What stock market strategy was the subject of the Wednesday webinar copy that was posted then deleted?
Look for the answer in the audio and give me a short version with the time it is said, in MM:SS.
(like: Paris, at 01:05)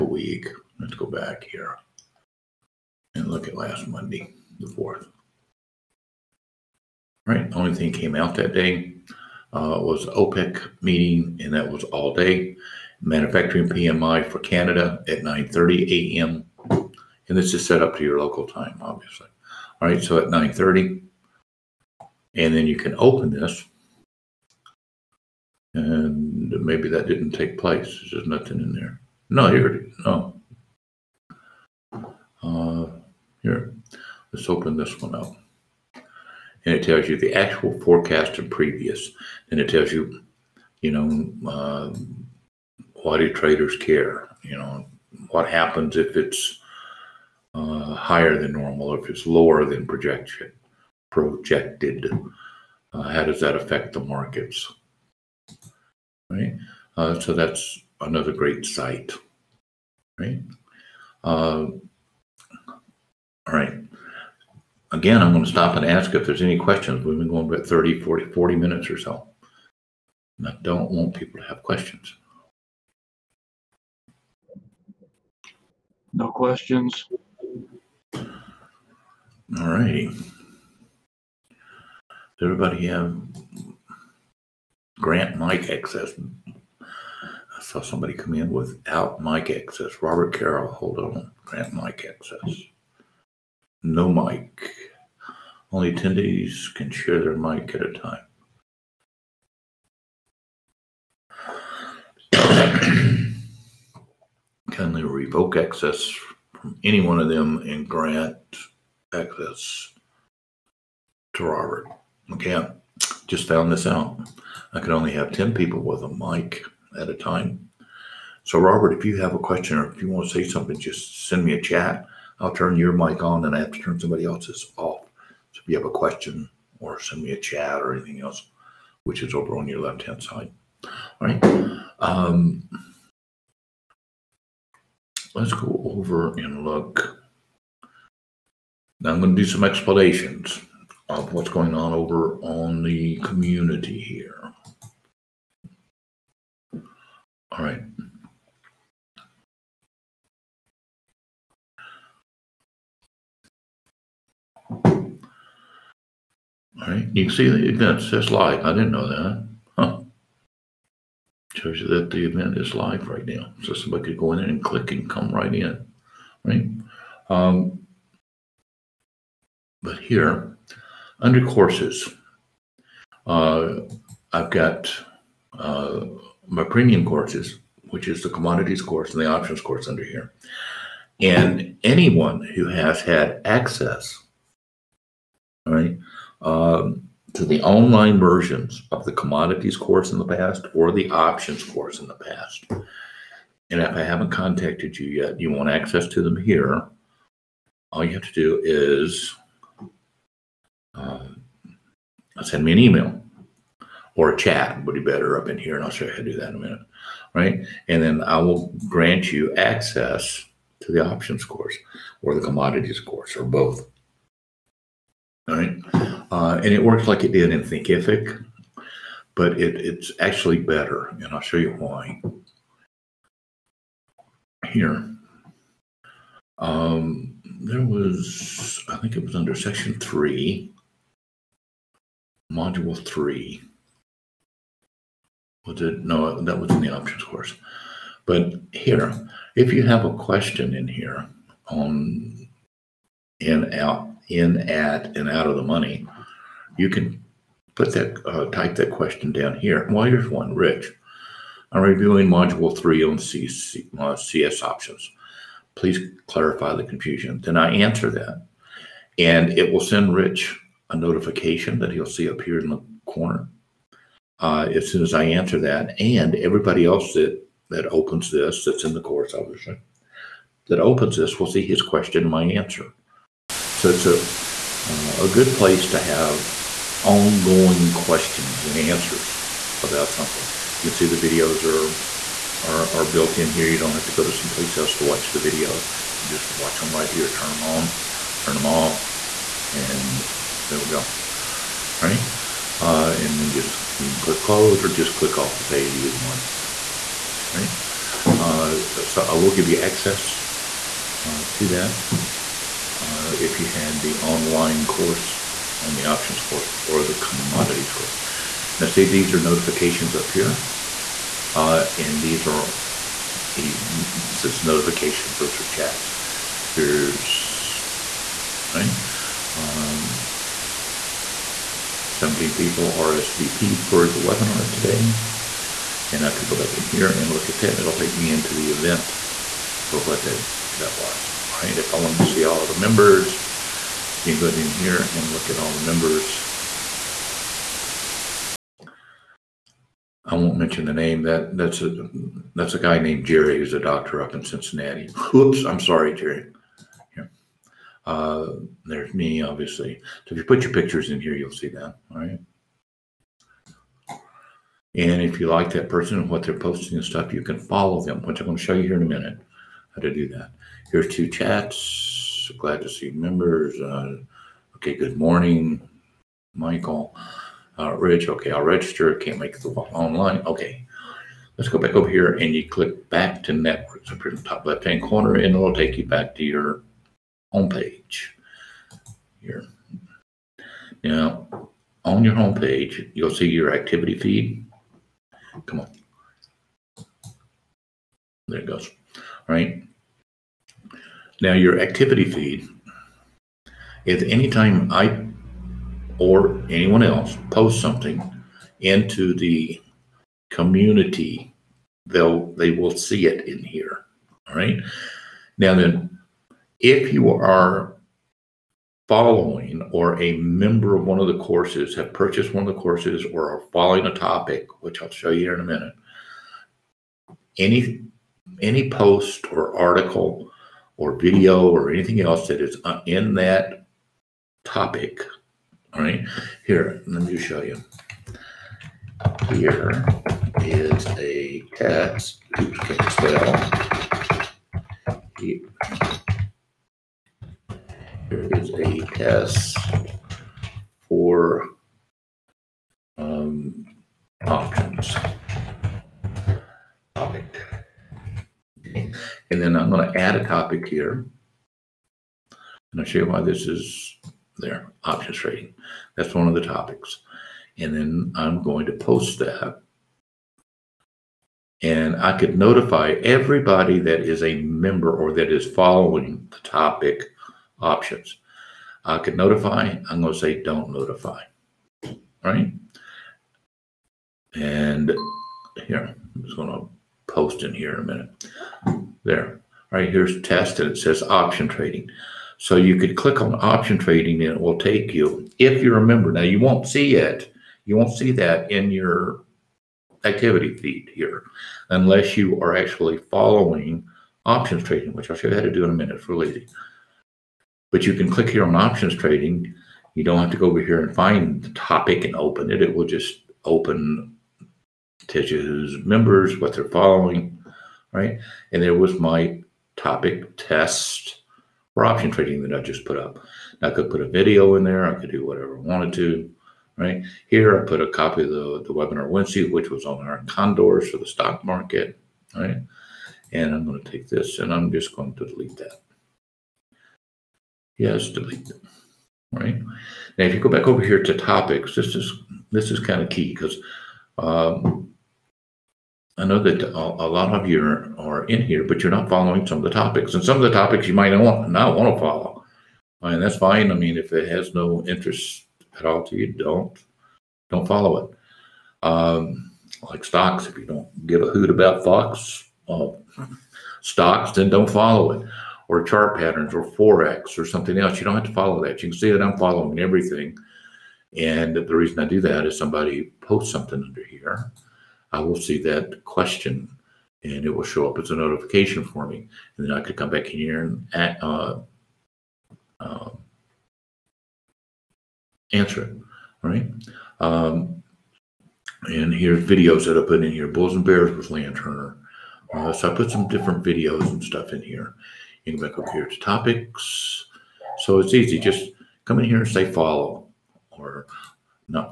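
Iron condors, at 08:40.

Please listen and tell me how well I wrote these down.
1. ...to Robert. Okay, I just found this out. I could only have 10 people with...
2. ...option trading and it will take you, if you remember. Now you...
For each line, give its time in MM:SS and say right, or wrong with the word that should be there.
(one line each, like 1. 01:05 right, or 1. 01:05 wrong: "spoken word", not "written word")
1. 01:51 right
2. 08:03 right.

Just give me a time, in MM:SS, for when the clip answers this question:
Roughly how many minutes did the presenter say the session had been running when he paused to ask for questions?
01:07.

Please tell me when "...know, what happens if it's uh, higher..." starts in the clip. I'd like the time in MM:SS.
00:44.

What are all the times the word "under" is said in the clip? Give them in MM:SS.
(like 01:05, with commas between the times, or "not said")
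02:51, 02:59, 03:49, 09:24.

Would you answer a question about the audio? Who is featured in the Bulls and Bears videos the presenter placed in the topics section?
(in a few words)
Land Turner.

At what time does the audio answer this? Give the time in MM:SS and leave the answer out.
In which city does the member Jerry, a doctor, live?
05:44.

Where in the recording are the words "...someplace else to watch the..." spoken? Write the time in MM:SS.
04:44.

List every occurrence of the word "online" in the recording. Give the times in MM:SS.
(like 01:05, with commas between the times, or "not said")
03:07, 05:04, 06:09.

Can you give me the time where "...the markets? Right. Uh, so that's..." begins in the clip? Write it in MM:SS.
00:53.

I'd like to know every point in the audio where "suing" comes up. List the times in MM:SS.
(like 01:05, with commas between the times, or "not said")
not said.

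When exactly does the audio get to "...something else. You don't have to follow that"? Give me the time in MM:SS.
09:17.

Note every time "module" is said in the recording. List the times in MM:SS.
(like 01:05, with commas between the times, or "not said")
03:52, 04:12.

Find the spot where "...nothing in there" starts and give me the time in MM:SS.
00:28.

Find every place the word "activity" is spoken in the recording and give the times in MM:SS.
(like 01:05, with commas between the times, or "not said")
06:23, 06:31, 08:10.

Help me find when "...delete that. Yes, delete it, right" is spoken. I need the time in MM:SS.
08:45.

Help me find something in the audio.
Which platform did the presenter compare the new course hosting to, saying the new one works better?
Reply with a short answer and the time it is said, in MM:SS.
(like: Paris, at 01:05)
Thinkific, at 03:37.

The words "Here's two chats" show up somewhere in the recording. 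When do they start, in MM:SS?
06:00.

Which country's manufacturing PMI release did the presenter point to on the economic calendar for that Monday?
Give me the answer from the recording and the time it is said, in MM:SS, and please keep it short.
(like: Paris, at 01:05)
Canada, at 00:14.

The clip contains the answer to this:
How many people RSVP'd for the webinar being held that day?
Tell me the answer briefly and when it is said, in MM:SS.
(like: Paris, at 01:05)
17, at 05:22.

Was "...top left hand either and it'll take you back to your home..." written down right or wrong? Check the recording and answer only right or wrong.
wrong.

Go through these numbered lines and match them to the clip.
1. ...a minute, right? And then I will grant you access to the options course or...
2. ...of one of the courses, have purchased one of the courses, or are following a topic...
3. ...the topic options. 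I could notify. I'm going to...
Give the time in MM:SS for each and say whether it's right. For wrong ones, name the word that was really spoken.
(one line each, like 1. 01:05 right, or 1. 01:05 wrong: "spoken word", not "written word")
1. 03:26 right
2. 06:50 right
3. 07:46 right.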